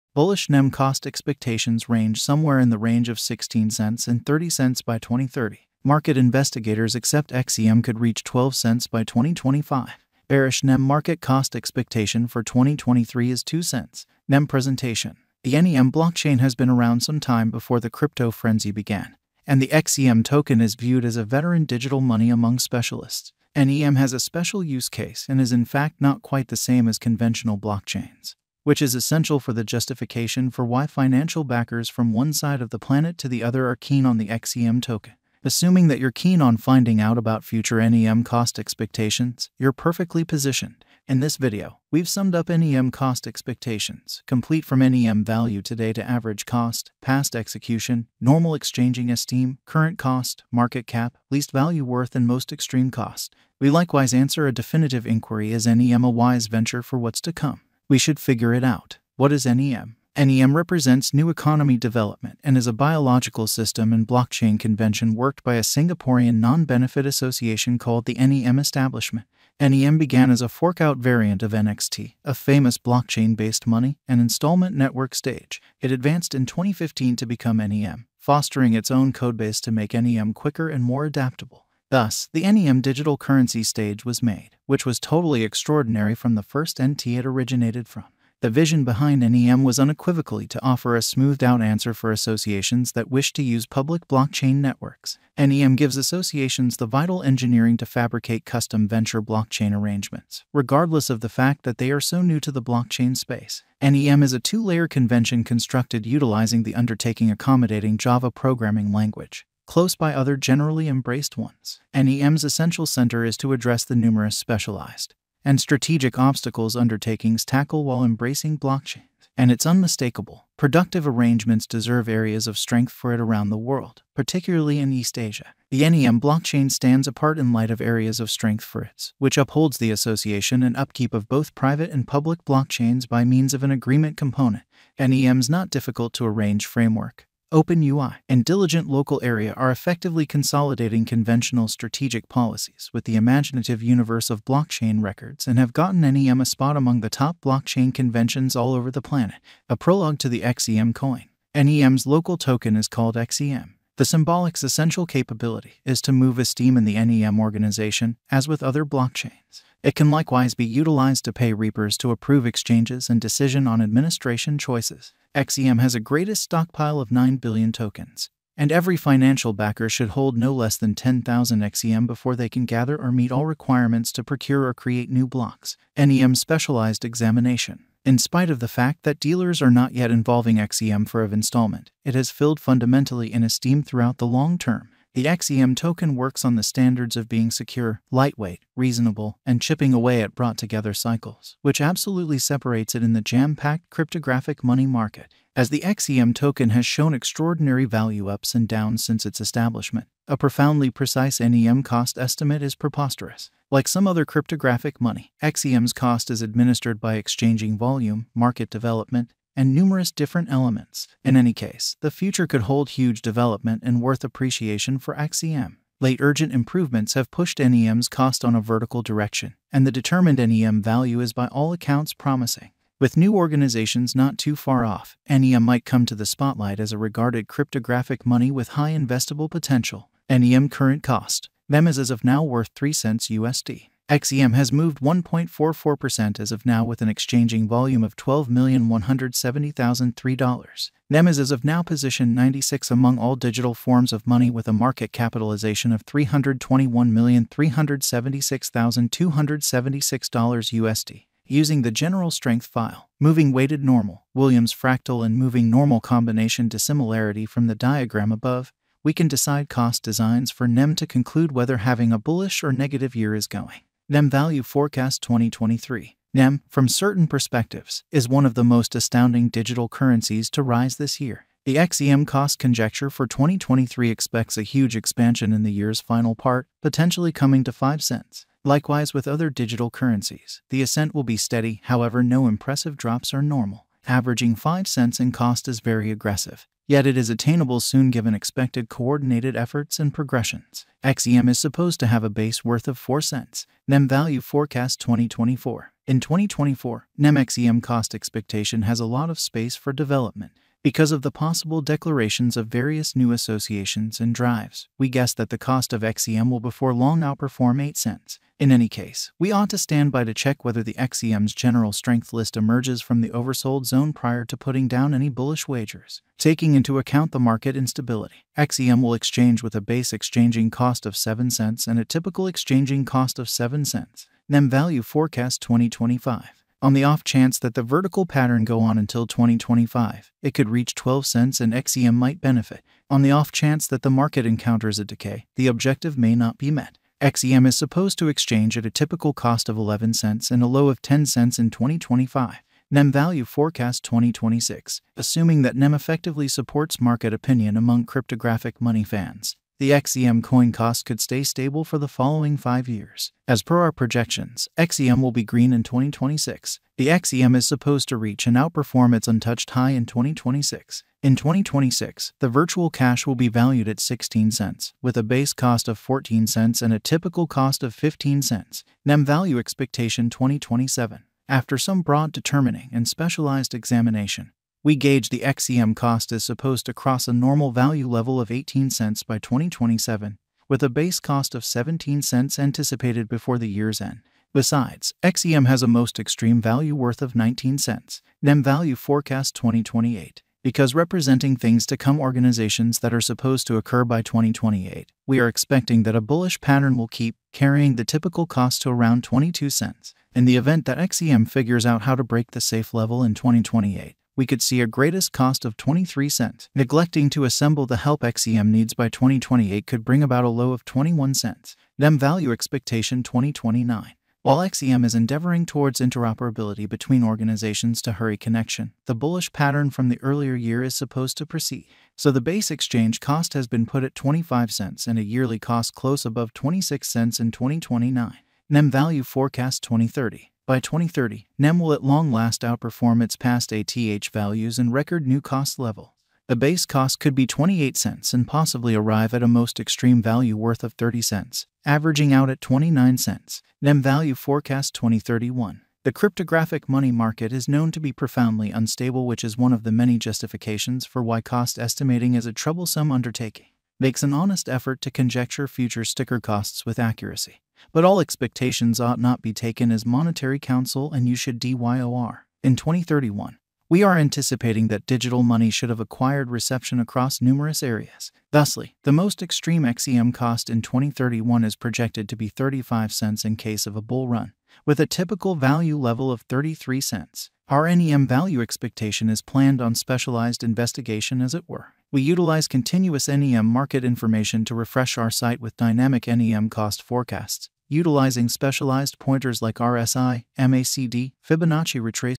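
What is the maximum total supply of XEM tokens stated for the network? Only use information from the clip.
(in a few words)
9 billion.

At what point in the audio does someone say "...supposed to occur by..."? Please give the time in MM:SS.
06:33.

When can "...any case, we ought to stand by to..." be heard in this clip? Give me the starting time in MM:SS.
05:08.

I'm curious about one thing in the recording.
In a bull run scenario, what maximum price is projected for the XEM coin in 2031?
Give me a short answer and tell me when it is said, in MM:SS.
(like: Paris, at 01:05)
35 cents, at 07:52.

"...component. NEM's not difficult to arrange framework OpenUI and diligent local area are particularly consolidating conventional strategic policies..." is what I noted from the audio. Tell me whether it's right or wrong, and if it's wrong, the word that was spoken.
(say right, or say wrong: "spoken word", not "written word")
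wrong: "effectively", not "particularly".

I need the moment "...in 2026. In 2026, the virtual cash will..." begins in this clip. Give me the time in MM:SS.
05:59.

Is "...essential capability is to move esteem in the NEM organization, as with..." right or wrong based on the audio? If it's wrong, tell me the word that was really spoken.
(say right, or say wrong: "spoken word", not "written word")
right.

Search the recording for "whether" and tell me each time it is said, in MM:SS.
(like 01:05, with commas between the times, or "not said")
04:21, 05:10.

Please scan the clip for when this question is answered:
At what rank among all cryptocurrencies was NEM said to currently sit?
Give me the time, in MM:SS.
04:02.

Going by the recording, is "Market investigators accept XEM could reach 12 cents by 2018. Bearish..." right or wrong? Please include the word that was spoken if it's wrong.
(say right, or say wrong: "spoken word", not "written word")
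wrong: "2025", not "2018".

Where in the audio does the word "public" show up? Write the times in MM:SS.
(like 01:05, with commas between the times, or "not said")
01:33, 02:12.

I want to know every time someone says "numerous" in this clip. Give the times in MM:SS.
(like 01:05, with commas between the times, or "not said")
01:53, 03:29, 07:47.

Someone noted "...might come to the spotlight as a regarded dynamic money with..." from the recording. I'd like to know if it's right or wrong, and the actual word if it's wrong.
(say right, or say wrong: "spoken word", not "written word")
wrong: "cryptographic", not "dynamic".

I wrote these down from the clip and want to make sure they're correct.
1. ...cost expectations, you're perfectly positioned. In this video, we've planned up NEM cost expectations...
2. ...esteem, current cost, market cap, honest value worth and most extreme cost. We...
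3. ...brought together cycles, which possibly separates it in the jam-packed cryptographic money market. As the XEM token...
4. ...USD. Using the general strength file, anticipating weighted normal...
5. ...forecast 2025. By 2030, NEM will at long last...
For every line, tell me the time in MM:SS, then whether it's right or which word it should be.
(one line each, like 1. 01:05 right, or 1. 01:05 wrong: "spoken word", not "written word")
1. 00:38 wrong: "summed", not "planned"
2. 00:49 wrong: "least", not "honest"
3. 03:10 wrong: "absolutely", not "possibly"
4. 04:10 wrong: "moving", not "anticipating"
5. 07:09 wrong: "2030", not "2025".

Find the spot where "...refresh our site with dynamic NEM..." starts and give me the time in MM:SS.
08:04.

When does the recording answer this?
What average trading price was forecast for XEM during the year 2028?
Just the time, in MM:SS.
06:39.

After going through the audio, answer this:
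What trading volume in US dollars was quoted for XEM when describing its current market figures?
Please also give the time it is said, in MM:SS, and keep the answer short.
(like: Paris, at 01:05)
$12,170,003, at 03:58.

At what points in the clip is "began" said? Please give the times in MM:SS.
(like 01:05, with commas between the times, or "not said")
00:18, 01:09.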